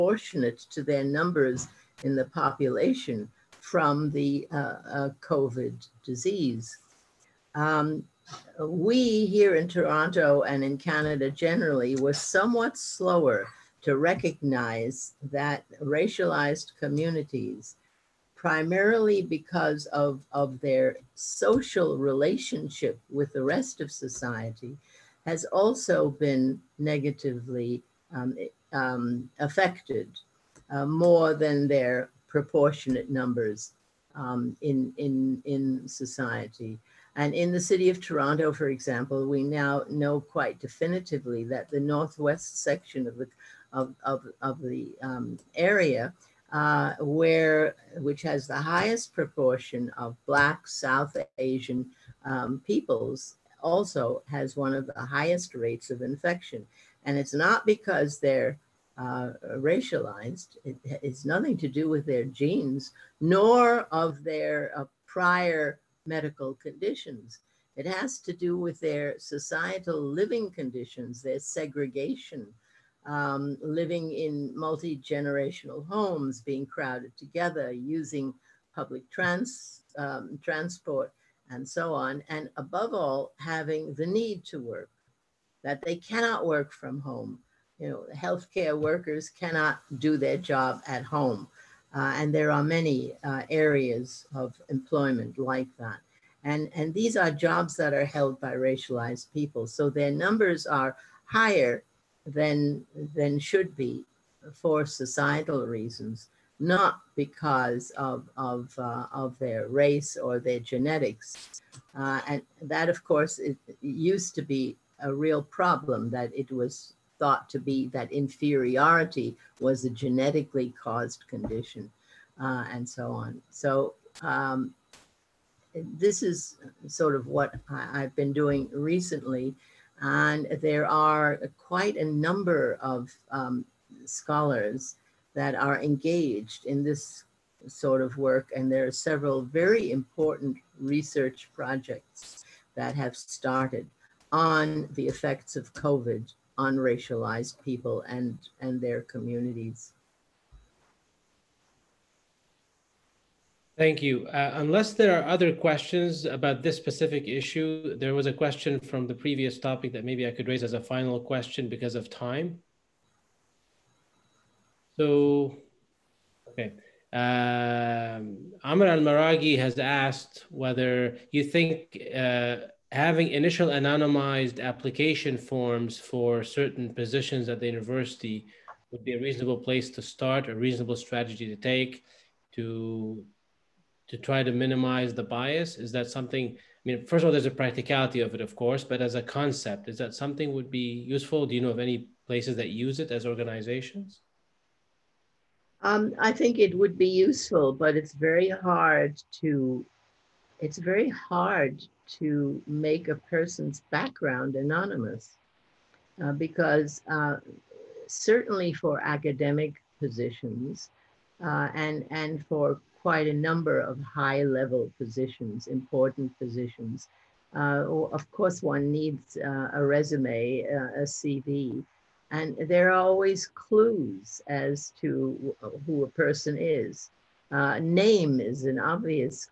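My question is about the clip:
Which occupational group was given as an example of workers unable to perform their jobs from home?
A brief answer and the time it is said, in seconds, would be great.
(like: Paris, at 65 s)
Healthcare workers, at 88 s.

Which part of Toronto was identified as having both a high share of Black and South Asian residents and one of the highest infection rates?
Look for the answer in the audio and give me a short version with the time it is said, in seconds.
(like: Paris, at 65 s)
Northwest section, at 41 s.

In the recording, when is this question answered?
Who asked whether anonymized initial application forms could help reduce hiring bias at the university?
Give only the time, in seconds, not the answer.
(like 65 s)
168 s.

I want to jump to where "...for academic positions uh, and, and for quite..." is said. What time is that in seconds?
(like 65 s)
208 s.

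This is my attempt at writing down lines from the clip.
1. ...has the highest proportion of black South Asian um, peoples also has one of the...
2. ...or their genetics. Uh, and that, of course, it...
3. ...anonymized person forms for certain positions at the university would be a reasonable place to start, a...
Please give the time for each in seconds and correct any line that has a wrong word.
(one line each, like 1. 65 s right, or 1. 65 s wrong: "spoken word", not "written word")
1. 48 s right
2. 110 s right
3. 173 s wrong: "application", not "person".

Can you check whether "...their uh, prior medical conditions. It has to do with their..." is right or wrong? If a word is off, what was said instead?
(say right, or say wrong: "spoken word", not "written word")
right.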